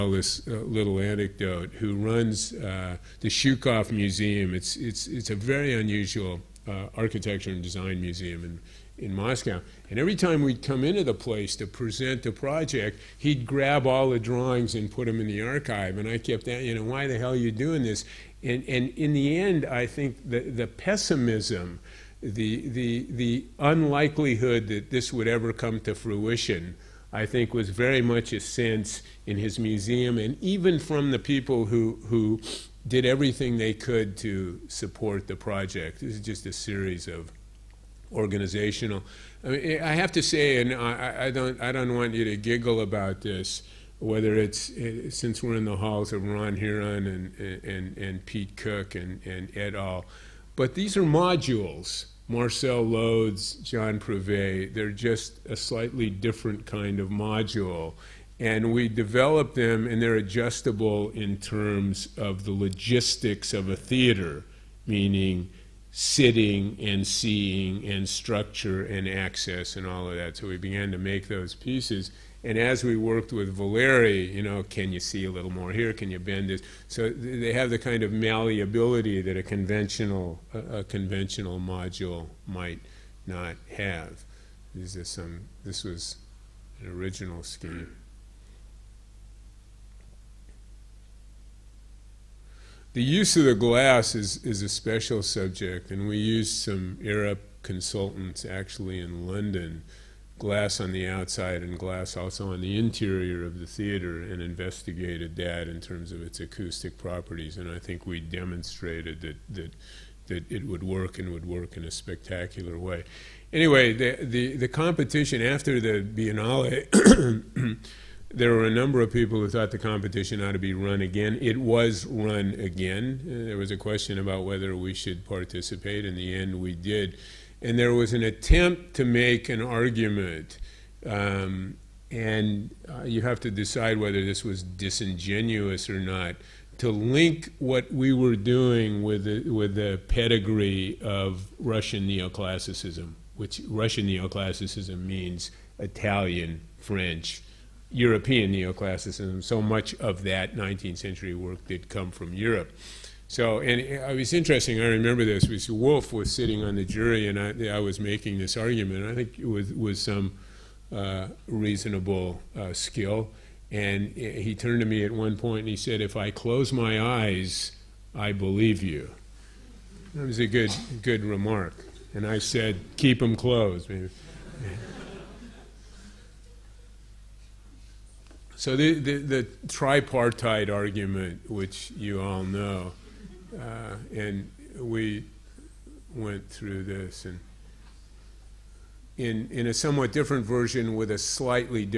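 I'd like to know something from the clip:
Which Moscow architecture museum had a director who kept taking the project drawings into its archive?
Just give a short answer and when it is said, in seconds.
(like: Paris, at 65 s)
Shchusev Museum, at 3 s.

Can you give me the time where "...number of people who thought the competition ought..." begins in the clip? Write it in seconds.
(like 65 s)
118 s.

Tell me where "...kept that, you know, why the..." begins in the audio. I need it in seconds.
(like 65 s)
16 s.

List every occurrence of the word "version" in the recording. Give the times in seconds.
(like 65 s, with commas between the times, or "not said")
190 s.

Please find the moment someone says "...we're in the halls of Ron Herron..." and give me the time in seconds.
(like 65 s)
45 s.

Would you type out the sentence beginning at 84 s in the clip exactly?
This is some, this was an original scheme.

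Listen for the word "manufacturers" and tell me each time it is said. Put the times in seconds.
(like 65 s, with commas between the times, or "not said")
not said.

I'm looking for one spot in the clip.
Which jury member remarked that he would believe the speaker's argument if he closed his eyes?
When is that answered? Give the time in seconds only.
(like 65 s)
155 s.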